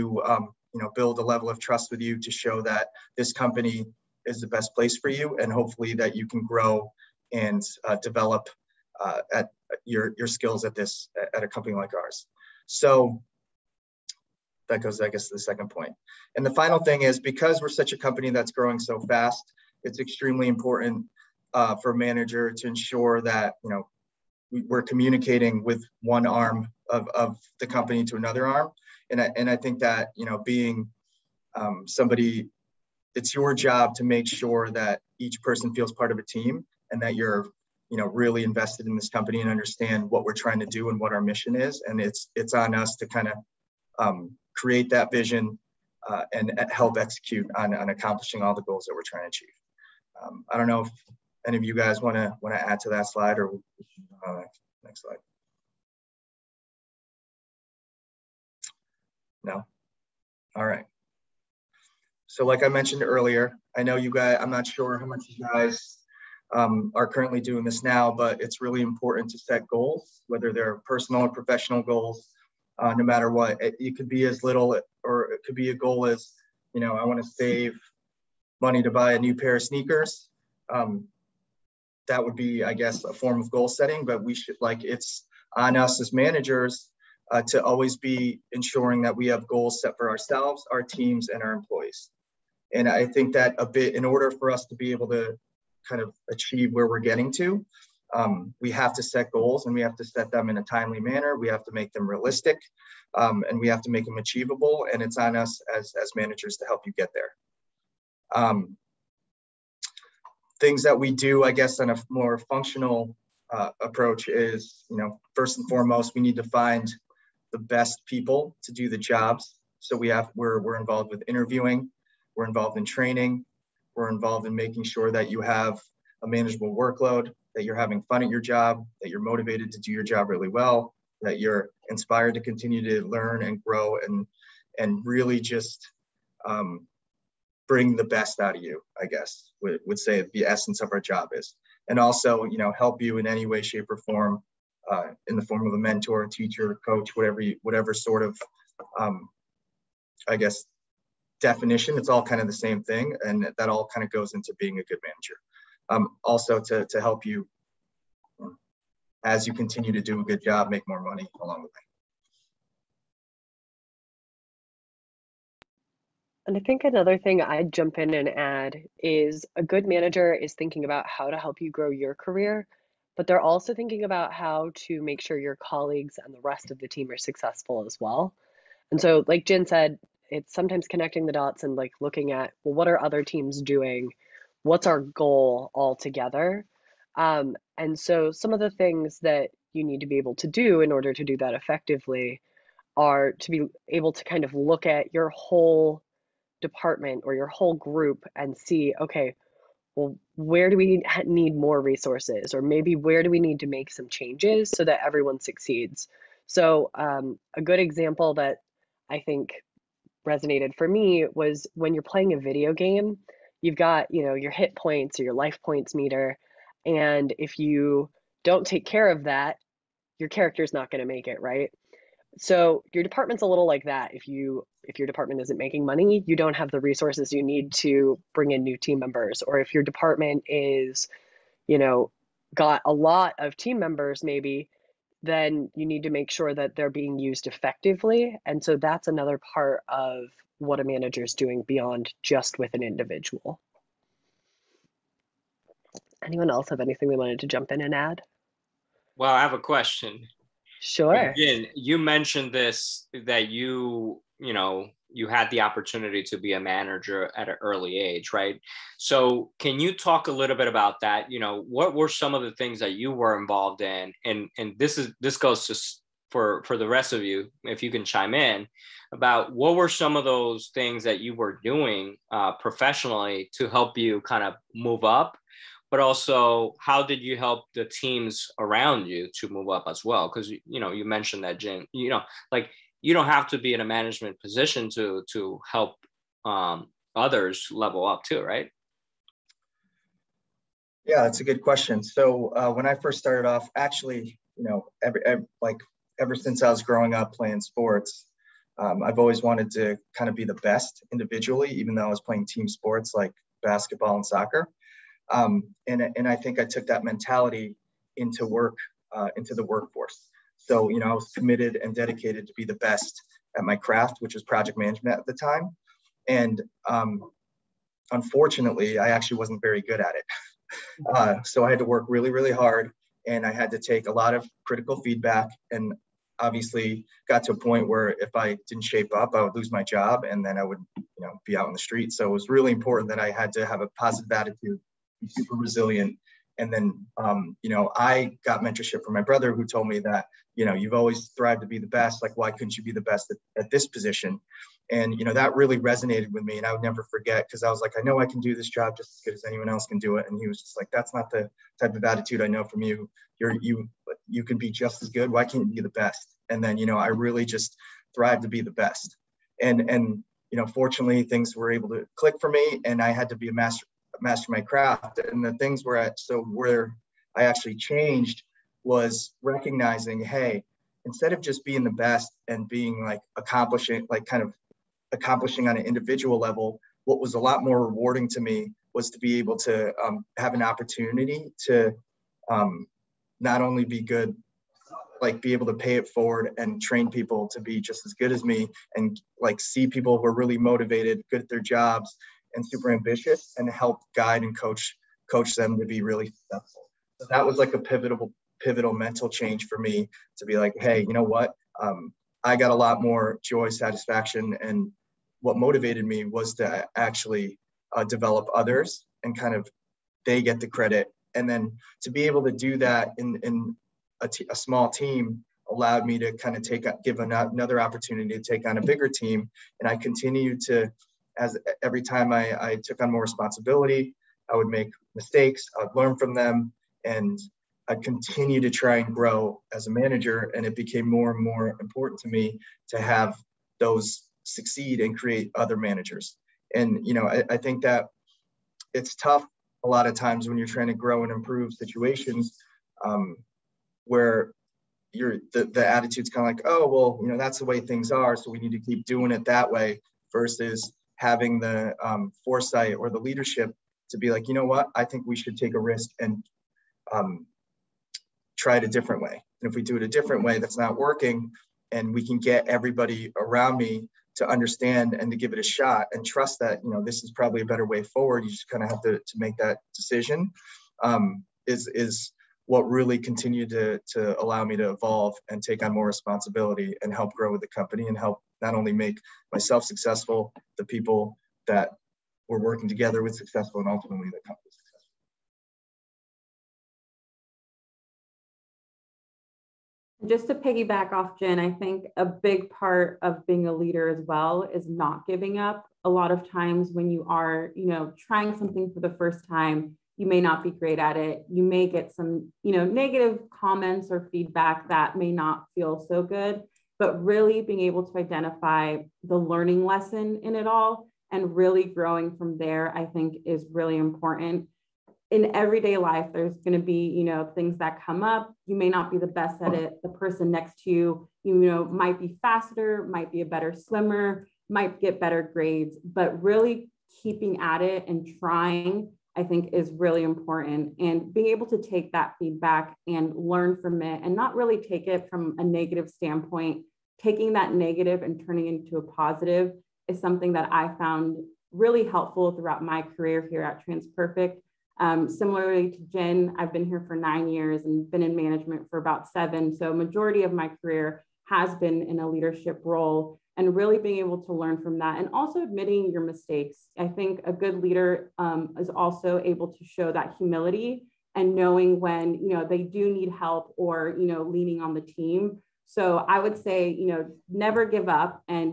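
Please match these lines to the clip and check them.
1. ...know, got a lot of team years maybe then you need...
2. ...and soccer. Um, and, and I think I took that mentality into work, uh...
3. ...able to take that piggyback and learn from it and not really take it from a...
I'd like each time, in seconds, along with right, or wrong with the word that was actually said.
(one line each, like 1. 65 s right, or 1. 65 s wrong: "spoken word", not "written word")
1. 231 s wrong: "members", not "years"
2. 304 s right
3. 531 s wrong: "feedback", not "piggyback".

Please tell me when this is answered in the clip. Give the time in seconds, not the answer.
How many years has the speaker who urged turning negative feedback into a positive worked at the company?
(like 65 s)
547 s.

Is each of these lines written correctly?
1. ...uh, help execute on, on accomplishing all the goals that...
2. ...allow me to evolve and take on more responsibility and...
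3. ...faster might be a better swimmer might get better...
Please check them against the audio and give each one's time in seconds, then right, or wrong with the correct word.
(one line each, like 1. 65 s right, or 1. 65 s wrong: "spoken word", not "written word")
1. 46 s right
2. 474 s right
3. 522 s right.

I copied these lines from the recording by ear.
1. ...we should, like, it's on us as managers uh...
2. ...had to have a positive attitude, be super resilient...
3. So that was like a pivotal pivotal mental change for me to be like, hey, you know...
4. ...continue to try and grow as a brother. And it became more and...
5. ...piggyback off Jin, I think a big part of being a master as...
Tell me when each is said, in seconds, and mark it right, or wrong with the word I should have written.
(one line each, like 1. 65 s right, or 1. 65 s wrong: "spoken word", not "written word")
1. 84 s right
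2. 333 s right
3. 397 s right
4. 428 s wrong: "manager", not "brother"
5. 490 s wrong: "leader", not "master".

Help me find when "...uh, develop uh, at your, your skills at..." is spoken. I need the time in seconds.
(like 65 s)
7 s.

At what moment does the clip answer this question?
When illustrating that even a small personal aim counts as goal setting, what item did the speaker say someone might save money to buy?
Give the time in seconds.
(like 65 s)
79 s.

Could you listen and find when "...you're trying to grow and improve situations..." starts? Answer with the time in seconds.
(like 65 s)
440 s.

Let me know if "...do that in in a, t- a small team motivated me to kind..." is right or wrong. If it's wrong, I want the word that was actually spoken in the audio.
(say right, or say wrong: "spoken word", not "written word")
wrong: "allowed", not "motivated".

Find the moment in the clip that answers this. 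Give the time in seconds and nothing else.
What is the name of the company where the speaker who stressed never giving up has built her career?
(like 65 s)
543 s.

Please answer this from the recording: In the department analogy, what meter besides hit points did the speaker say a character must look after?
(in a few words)
life points.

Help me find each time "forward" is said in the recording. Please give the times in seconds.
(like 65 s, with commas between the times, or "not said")
386 s, 468 s.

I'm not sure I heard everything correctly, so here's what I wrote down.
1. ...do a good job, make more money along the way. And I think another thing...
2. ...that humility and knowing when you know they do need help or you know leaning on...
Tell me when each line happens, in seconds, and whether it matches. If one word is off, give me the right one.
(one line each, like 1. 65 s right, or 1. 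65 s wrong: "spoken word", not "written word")
1. 160 s right
2. 560 s right.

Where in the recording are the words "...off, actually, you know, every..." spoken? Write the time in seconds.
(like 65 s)
293 s.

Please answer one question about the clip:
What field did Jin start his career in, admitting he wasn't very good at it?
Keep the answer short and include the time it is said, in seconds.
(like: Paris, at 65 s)
project management, at 314 s.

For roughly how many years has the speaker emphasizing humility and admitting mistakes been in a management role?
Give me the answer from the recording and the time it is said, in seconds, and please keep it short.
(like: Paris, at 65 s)
7, at 549 s.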